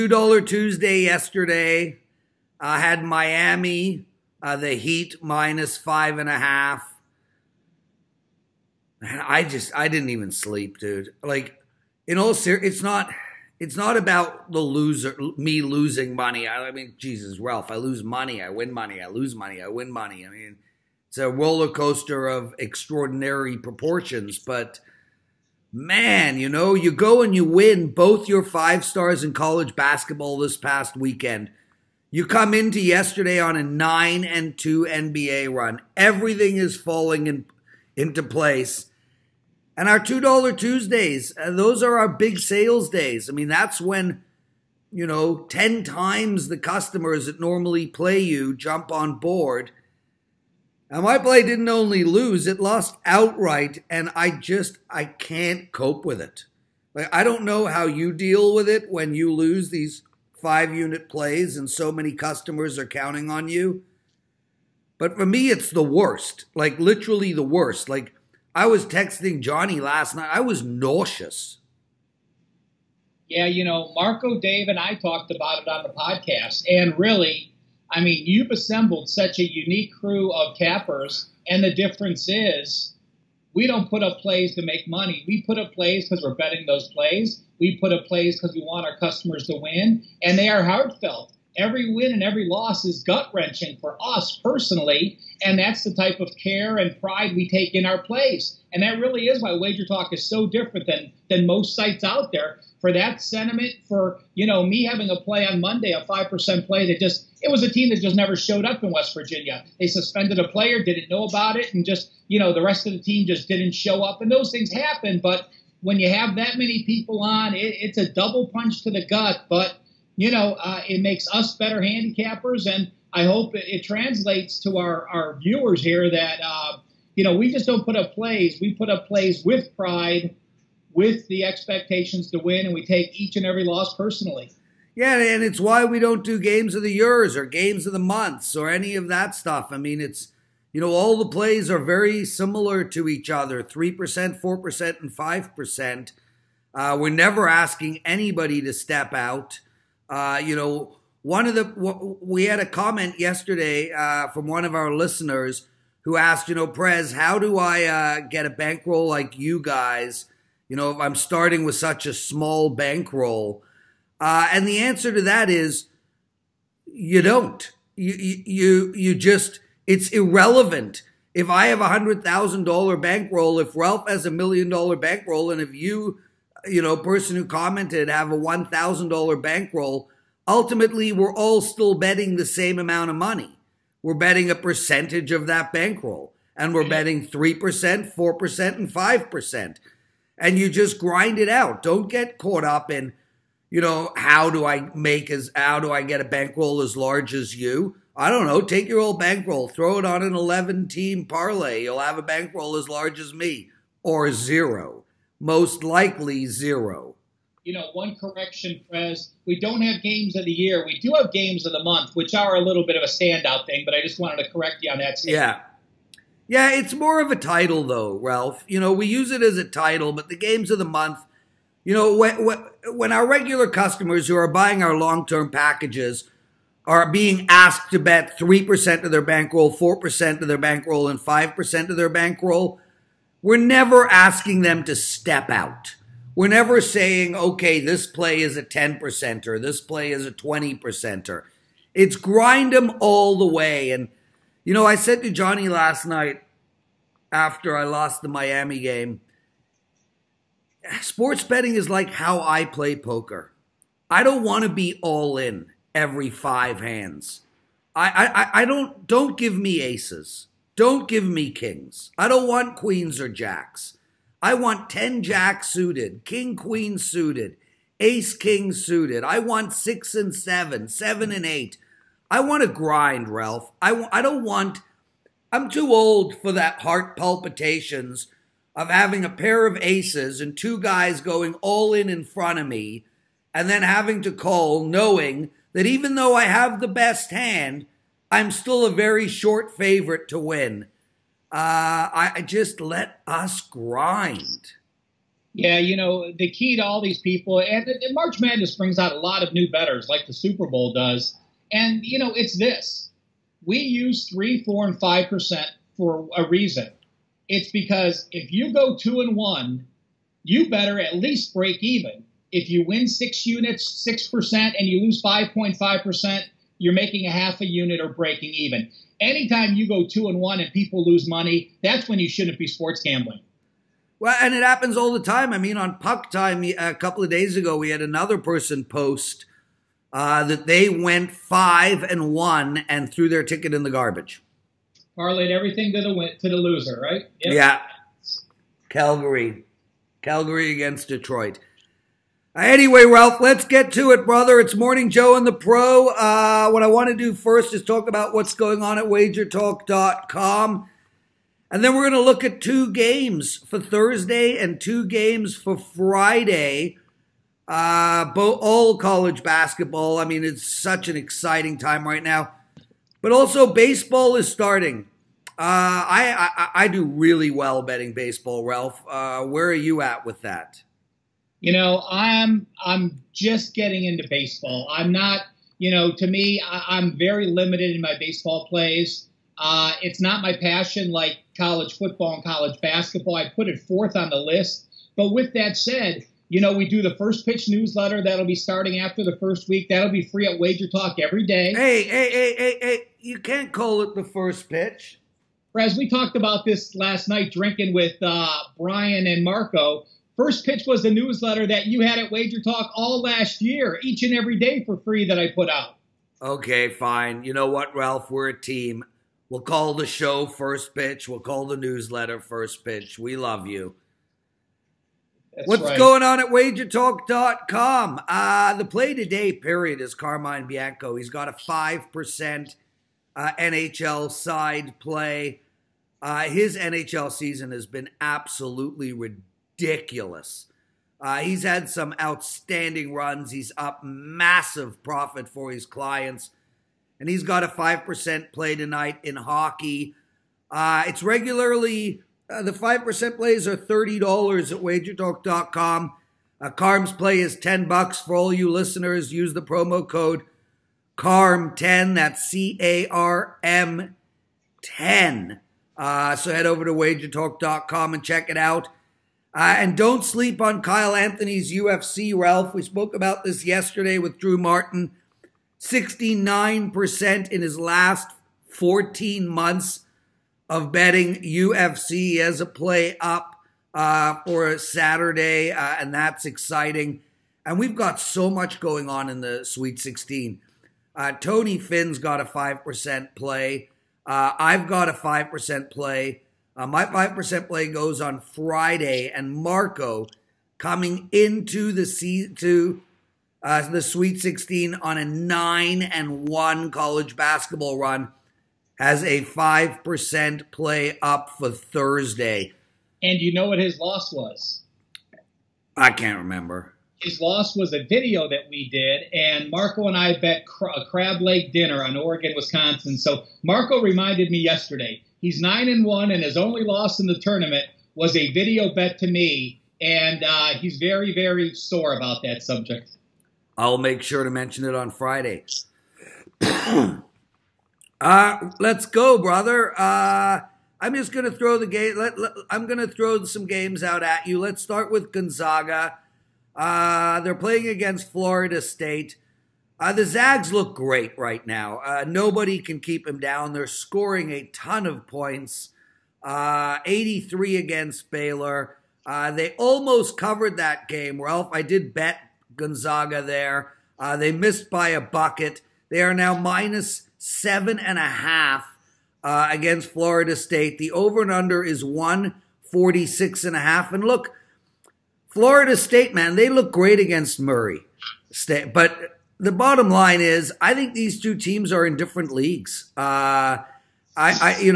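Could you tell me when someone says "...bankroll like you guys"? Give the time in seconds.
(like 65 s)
158 s.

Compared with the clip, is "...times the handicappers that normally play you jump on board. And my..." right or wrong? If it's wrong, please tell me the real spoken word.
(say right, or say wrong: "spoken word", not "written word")
wrong: "customers", not "handicappers".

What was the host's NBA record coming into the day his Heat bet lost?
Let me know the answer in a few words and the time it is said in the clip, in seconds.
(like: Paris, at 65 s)
9-2, at 33 s.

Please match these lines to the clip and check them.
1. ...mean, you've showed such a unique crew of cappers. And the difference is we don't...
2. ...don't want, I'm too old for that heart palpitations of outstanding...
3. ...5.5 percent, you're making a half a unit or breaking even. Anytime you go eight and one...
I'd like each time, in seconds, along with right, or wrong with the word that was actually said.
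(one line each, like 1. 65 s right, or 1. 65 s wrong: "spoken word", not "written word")
1. 77 s wrong: "assembled", not "showed"
2. 274 s wrong: "having", not "outstanding"
3. 315 s wrong: "two", not "eight".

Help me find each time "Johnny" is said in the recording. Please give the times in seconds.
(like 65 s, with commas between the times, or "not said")
69 s, 245 s.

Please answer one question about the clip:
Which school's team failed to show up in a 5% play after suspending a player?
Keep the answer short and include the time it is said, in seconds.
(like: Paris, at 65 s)
West Virginia, at 108 s.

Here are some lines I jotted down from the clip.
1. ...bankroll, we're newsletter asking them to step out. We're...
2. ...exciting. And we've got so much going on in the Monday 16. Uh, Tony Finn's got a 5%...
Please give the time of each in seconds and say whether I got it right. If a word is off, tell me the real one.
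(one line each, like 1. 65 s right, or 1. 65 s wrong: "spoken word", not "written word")
1. 232 s wrong: "never", not "newsletter"
2. 476 s wrong: "Sweet", not "Monday".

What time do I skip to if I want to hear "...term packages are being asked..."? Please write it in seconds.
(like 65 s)
225 s.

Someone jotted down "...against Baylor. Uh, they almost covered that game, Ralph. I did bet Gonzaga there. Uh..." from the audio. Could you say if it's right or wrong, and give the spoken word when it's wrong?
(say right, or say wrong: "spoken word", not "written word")
right.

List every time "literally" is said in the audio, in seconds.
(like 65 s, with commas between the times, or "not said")
66 s.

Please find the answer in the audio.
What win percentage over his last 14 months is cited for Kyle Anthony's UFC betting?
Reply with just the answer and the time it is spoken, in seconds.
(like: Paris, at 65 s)
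69%, at 465 s.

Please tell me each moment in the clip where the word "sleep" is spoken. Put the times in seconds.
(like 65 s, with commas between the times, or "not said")
10 s, 460 s.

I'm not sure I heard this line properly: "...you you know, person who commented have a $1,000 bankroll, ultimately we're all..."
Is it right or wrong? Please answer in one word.
right.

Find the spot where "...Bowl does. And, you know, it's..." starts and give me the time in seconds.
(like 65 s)
300 s.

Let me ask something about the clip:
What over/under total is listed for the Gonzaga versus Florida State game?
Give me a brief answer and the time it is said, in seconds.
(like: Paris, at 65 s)
146.5, at 562 s.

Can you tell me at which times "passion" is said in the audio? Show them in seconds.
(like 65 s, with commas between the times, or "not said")
380 s.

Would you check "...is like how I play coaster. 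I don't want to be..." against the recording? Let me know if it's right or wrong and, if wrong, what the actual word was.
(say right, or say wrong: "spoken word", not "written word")
wrong: "poker", not "coaster".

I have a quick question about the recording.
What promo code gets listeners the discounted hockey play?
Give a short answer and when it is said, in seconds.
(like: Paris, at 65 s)
CARM10, at 451 s.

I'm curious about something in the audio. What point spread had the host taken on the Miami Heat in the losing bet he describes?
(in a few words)
-5.5.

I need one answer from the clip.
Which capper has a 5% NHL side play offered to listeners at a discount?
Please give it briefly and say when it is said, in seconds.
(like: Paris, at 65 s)
Carmine Bianco, at 420 s.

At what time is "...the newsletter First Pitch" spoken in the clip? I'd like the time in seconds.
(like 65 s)
411 s.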